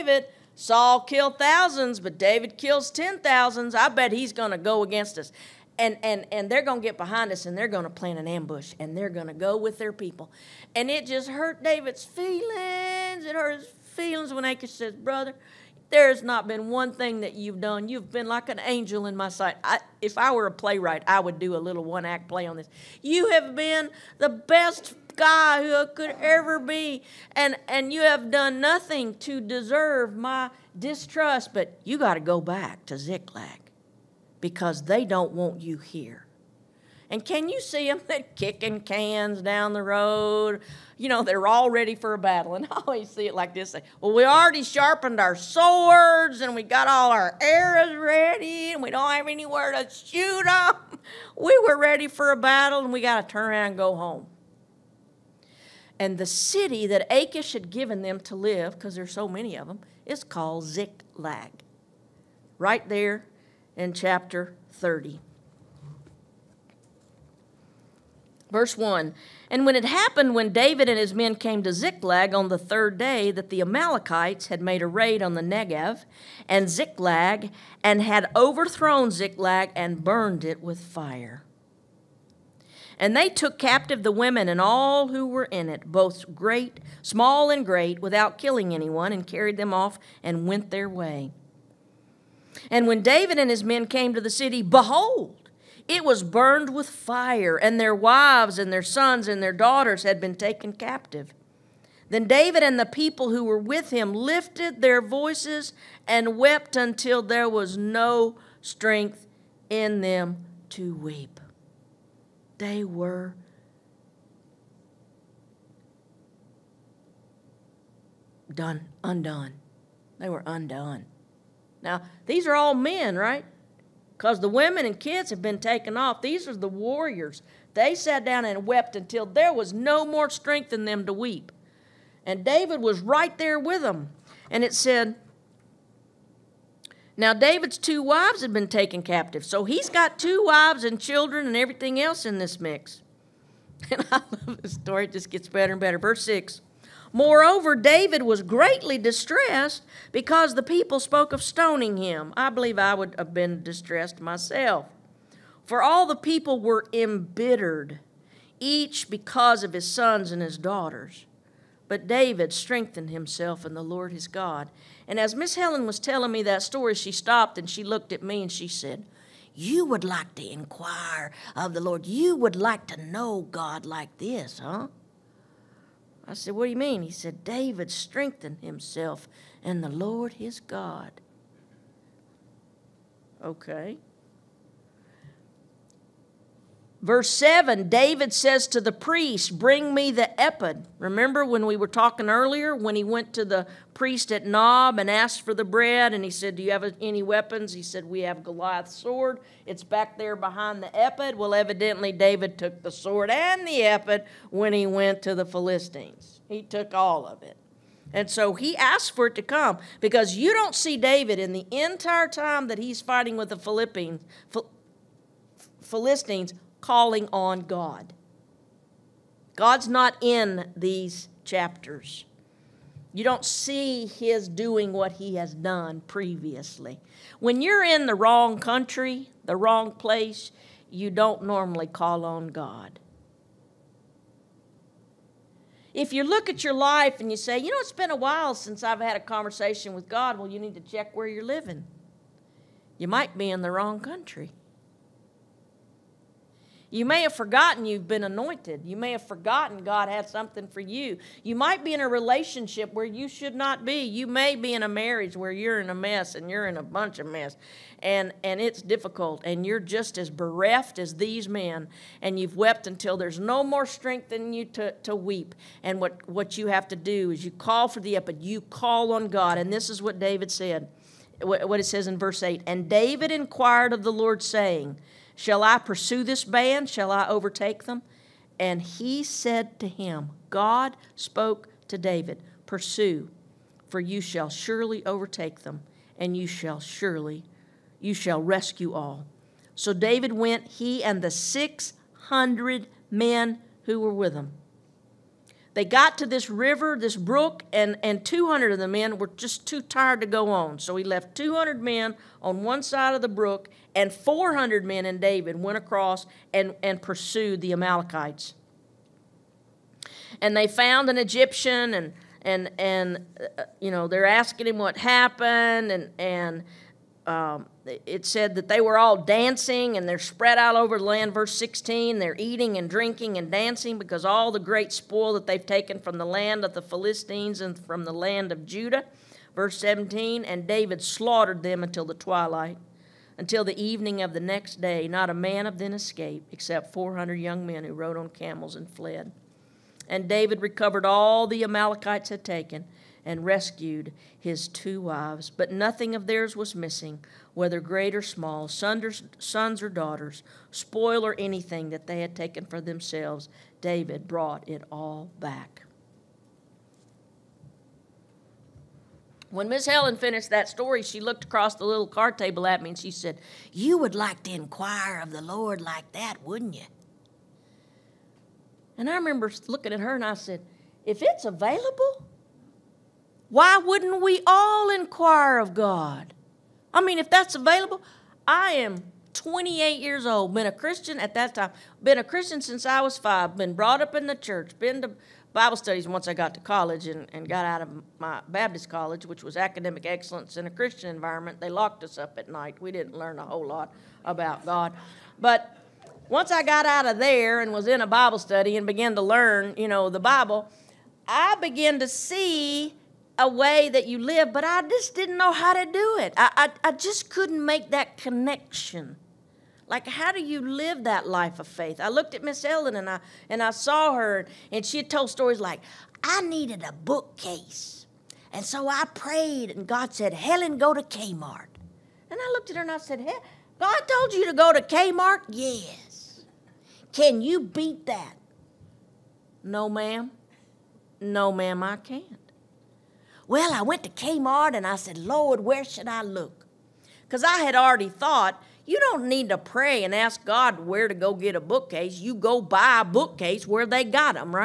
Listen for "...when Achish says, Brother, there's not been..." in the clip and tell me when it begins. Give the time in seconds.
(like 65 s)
14 s.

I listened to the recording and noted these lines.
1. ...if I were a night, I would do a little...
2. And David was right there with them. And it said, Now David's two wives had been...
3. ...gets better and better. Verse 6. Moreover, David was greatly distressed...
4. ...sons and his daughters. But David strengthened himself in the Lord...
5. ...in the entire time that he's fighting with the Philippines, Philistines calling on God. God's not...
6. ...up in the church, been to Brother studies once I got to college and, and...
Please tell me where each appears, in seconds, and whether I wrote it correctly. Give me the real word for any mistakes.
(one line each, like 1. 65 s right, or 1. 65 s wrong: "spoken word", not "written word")
1. 20 s wrong: "playwright", not "night"
2. 132 s right
3. 145 s right
4. 159 s right
5. 211 s right
6. 384 s wrong: "Bible", not "Brother".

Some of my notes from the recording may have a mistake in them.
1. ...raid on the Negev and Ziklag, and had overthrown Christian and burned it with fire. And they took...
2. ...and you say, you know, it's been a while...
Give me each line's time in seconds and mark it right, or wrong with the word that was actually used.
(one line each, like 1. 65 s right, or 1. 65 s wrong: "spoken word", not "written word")
1. 74 s wrong: "Ziklag", not "Christian"
2. 237 s right.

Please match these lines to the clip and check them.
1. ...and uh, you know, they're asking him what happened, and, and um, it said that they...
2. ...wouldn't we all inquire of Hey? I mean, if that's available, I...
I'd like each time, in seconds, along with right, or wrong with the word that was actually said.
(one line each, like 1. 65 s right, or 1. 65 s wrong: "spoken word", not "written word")
1. 312 s right
2. 373 s wrong: "God", not "Hey".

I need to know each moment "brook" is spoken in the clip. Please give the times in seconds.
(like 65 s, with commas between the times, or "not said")
297 s, 303 s.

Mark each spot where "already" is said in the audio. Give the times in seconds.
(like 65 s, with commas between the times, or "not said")
44 s, 437 s.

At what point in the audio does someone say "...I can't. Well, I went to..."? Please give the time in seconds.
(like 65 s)
431 s.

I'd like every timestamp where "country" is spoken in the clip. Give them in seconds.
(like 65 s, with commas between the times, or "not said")
228 s, 243 s.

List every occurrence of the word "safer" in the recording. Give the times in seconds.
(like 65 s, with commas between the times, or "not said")
not said.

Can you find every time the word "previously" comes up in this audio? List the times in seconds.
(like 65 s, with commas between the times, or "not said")
226 s.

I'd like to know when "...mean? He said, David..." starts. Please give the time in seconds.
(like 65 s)
176 s.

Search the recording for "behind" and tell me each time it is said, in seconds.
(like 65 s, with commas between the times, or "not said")
6 s, 200 s.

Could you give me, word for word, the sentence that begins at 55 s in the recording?
And the city that Achish had given them to live, because there's so many of them, is called Ziklag.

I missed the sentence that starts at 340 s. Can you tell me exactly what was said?
And David recovered all the Amalekites had taken and rescued his two wives.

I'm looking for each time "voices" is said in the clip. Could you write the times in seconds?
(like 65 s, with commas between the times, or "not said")
105 s.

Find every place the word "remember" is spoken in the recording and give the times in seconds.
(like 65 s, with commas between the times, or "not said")
190 s, 369 s.